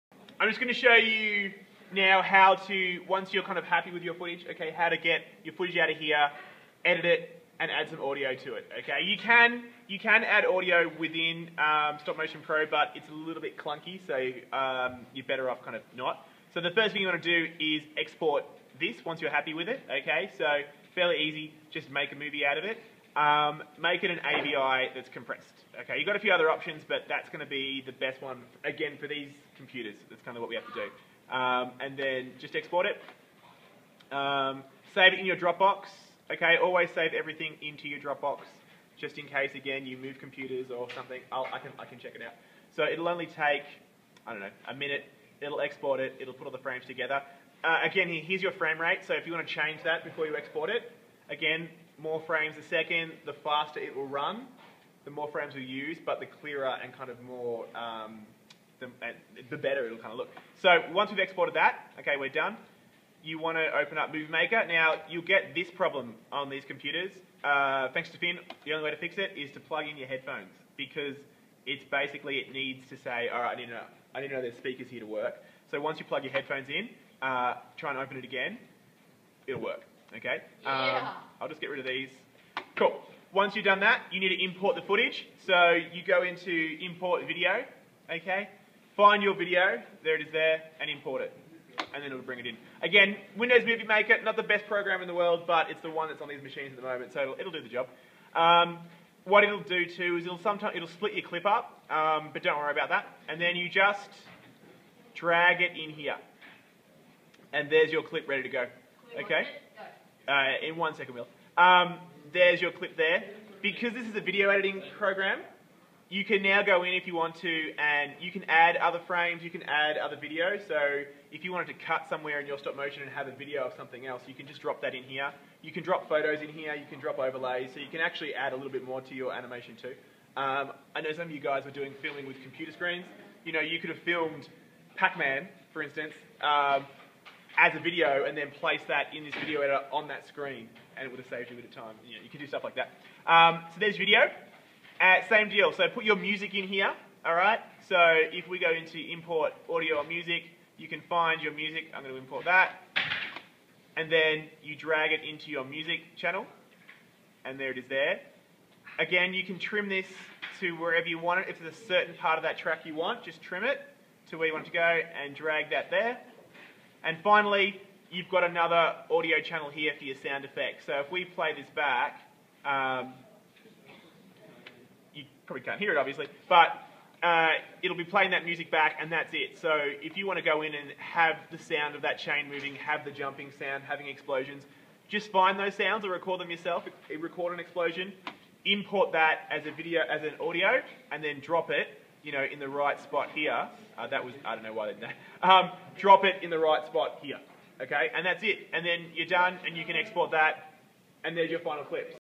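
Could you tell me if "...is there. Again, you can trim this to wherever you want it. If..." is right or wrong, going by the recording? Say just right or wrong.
right.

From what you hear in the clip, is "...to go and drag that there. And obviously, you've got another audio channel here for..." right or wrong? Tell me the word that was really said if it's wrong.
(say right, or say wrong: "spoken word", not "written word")
wrong: "finally", not "obviously".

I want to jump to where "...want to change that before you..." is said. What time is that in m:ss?
0:49.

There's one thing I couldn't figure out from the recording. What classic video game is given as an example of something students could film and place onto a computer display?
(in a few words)
Pac-Man.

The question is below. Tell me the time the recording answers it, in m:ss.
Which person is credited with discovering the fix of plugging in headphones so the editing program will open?
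1:08.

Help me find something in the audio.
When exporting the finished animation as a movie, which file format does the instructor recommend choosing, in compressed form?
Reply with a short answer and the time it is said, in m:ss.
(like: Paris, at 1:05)
AVI, at 0:24.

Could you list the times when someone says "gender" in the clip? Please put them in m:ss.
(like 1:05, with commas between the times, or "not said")
not said.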